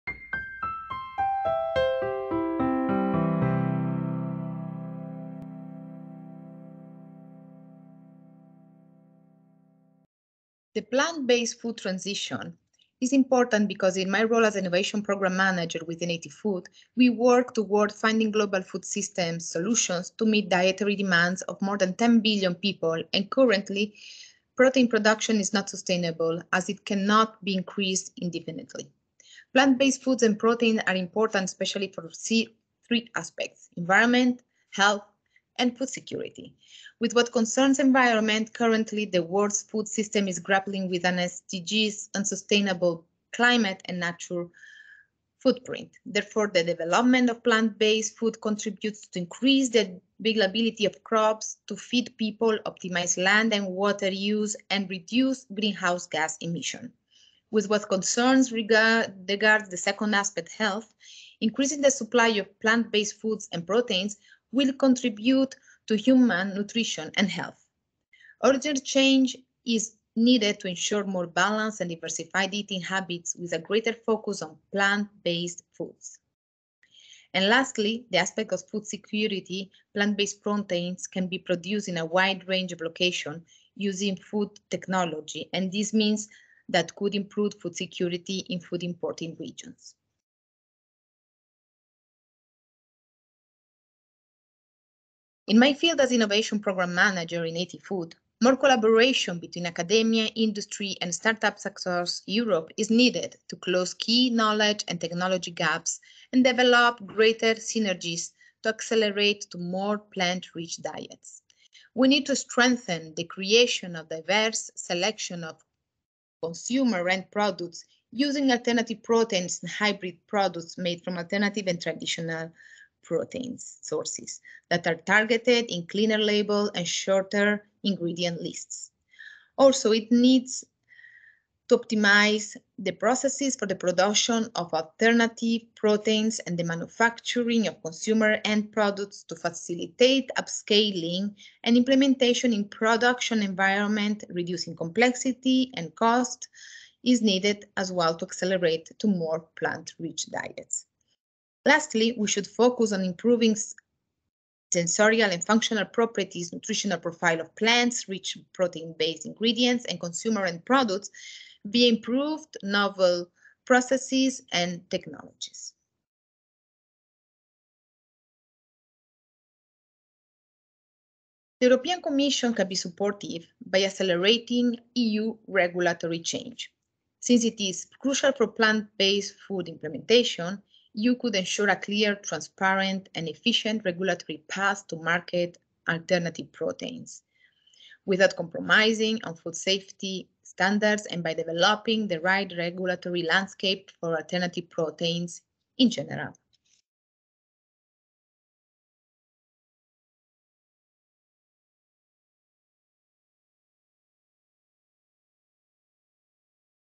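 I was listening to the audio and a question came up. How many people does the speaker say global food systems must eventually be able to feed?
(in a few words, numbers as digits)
more than 10 billion.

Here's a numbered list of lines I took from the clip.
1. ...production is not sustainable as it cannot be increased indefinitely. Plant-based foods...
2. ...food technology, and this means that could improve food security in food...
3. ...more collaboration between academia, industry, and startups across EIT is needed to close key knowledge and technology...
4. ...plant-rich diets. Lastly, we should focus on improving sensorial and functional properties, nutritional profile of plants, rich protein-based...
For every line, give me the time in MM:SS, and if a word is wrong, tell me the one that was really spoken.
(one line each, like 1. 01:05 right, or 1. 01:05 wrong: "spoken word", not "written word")
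1. 00:24 right
2. 01:24 right
3. 01:38 wrong: "Europe", not "EIT"
4. 02:29 right.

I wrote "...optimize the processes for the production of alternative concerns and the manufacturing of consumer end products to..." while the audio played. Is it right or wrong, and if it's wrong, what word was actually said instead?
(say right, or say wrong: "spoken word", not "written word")
wrong: "proteins", not "concerns".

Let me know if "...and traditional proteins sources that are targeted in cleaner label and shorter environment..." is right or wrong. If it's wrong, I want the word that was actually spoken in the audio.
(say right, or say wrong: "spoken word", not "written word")
wrong: "ingredient", not "environment".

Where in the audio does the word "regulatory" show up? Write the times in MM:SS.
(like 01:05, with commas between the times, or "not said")
02:55, 03:03, 03:12.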